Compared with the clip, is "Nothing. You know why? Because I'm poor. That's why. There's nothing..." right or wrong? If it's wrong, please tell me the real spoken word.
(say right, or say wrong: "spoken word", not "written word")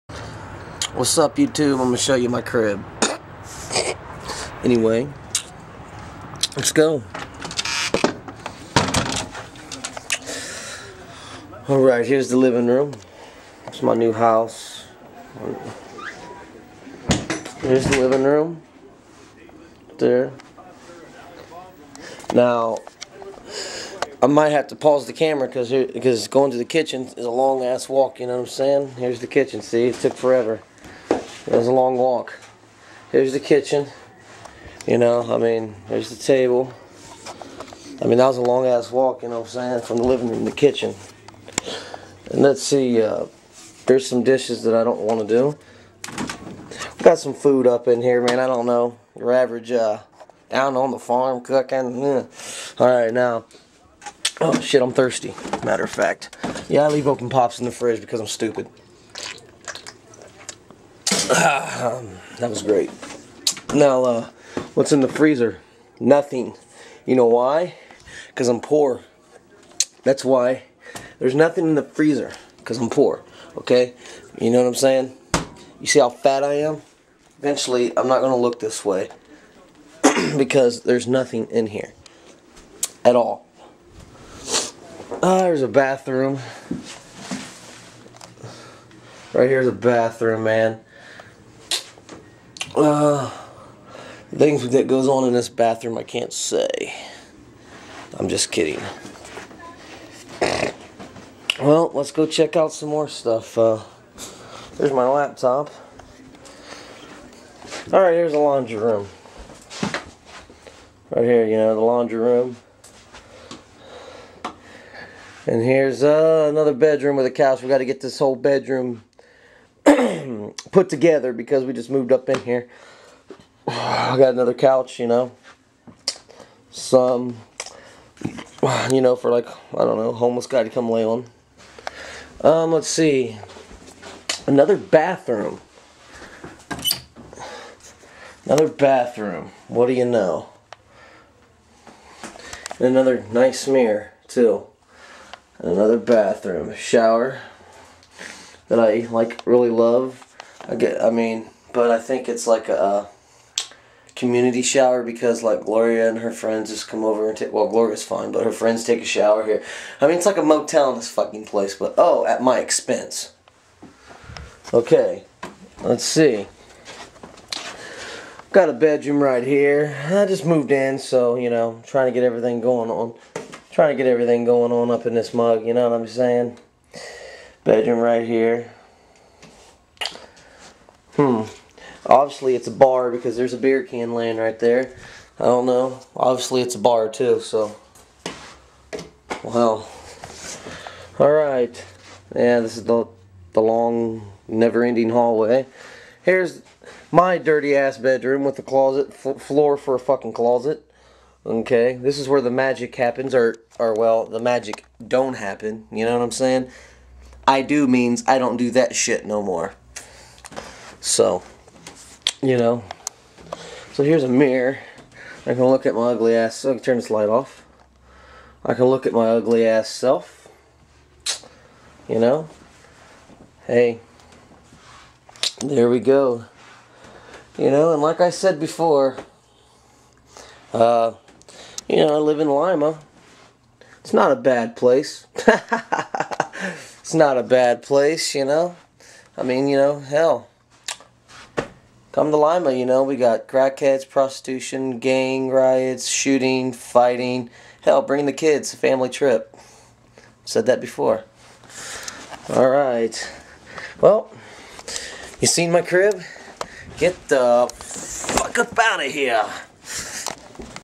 right.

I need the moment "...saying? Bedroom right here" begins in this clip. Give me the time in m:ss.
2:56.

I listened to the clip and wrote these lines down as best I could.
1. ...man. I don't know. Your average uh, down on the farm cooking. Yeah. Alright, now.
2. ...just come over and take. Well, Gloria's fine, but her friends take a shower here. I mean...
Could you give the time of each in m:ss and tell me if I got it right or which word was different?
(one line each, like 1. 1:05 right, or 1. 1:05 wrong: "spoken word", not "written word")
1. 0:48 right
2. 2:36 right.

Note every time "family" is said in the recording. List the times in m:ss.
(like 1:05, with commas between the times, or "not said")
4:08.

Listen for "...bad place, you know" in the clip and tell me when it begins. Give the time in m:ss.
3:57.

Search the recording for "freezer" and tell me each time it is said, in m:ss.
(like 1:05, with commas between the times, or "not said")
1:05, 1:11.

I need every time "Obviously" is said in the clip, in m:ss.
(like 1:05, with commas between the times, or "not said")
3:02, 3:06.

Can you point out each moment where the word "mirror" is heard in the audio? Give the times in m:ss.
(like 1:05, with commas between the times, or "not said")
2:23, 3:34.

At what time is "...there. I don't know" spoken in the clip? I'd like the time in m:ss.
3:04.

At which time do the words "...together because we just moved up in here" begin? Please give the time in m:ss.
2:00.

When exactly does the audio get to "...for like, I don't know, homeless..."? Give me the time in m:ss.
2:09.